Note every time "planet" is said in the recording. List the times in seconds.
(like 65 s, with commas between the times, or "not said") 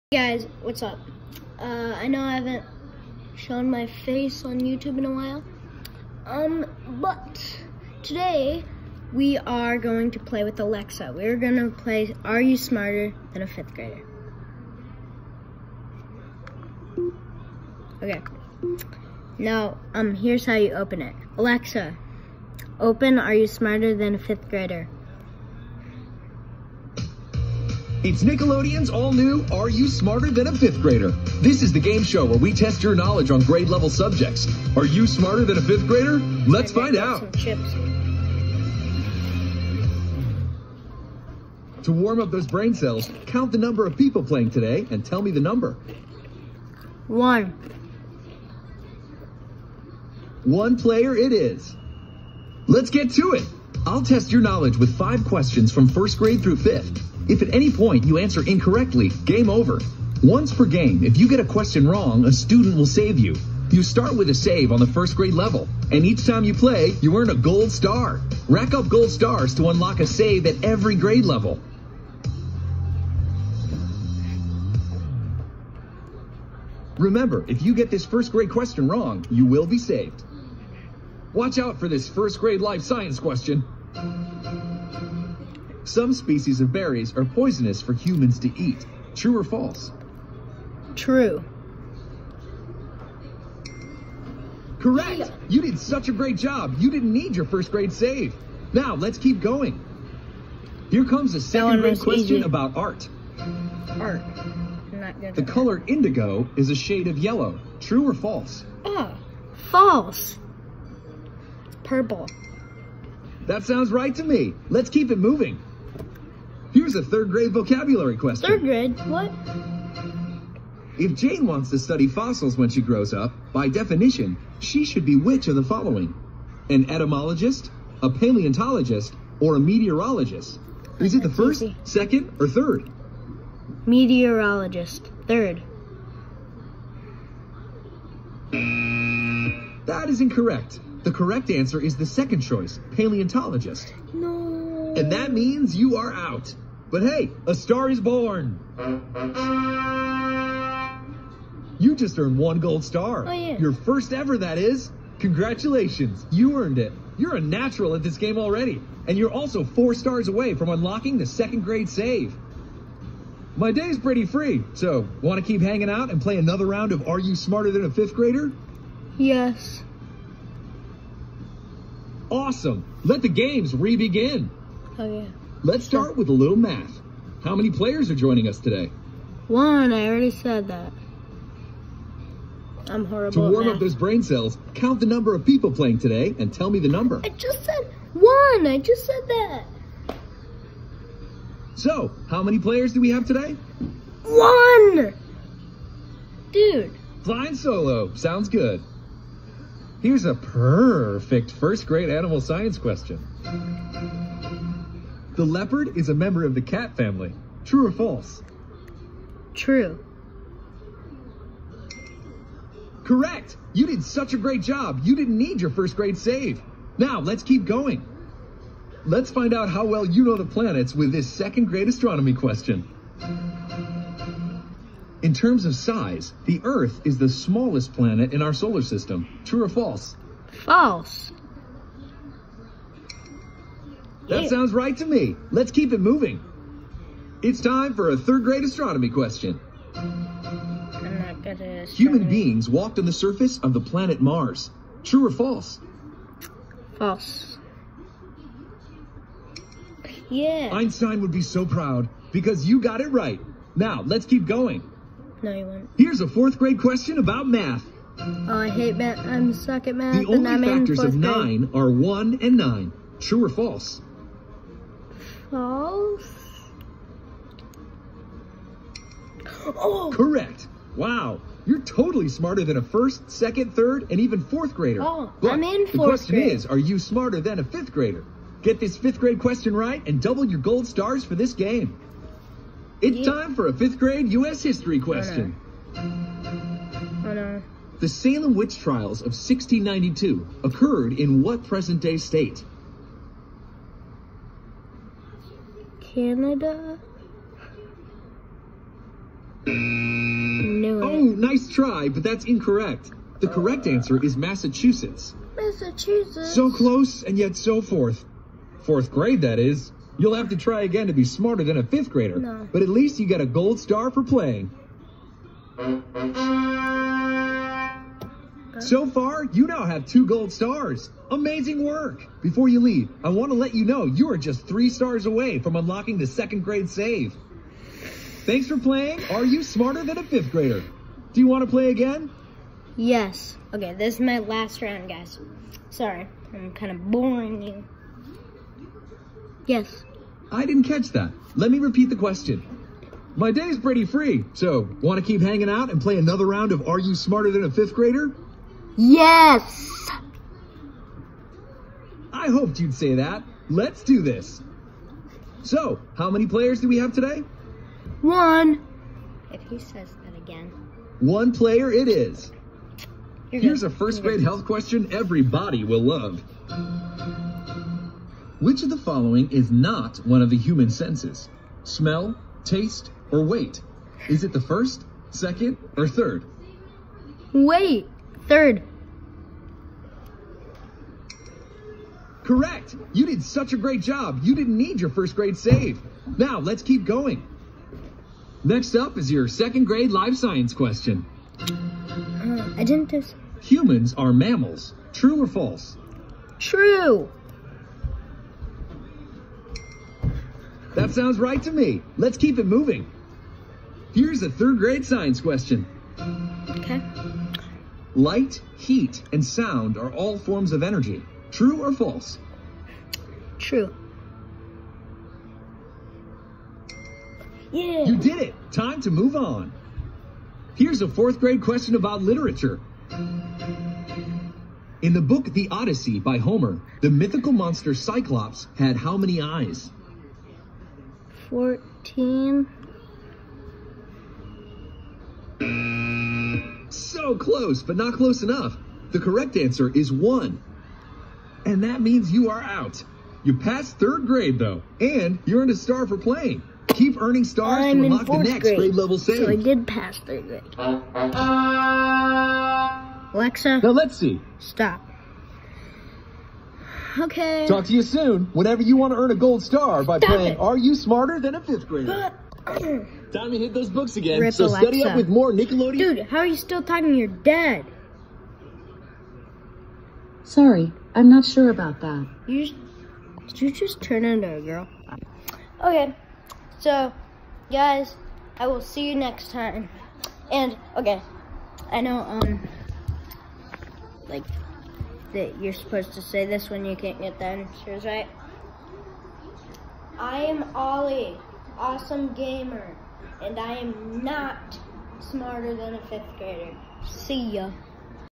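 220 s, 227 s, 243 s.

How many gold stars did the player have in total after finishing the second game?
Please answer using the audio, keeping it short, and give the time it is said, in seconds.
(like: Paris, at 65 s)
2, at 320 s.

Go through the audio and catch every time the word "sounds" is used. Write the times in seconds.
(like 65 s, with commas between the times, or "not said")
113 s, 198 s, 234 s, 401 s, 409 s.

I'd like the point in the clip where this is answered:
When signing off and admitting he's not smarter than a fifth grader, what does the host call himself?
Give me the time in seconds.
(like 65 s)
490 s.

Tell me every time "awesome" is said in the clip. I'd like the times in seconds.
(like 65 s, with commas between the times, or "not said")
172 s, 491 s.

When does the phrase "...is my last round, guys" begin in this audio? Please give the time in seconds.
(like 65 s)
334 s.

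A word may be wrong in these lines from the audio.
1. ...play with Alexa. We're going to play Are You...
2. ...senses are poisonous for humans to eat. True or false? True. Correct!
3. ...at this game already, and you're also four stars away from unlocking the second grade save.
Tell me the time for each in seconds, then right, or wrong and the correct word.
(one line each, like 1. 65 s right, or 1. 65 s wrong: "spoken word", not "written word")
1. 10 s right
2. 86 s wrong: "berries", not "senses"
3. 157 s right.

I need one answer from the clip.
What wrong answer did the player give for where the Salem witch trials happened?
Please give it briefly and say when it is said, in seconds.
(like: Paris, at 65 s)
Canada, at 296 s.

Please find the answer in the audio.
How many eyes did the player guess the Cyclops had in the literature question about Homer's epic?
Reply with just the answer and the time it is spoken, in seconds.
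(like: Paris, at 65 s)
14, at 431 s.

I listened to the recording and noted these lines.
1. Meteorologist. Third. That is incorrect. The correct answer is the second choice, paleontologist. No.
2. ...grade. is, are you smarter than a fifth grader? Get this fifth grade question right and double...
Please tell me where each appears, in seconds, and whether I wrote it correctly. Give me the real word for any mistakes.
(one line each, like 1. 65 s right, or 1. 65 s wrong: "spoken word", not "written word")
1. 133 s right
2. 276 s right.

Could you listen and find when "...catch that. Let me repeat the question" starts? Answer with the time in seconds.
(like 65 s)
340 s.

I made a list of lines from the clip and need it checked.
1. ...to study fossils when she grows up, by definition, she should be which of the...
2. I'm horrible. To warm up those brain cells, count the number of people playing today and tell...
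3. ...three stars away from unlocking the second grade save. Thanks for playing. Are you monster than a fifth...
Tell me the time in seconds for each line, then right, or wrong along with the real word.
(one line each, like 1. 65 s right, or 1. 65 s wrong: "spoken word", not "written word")
1. 121 s right
2. 182 s right
3. 324 s wrong: "smarter", not "monster".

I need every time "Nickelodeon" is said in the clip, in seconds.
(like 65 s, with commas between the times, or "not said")
28 s, 465 s.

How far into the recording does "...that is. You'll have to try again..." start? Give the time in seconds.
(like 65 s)
309 s.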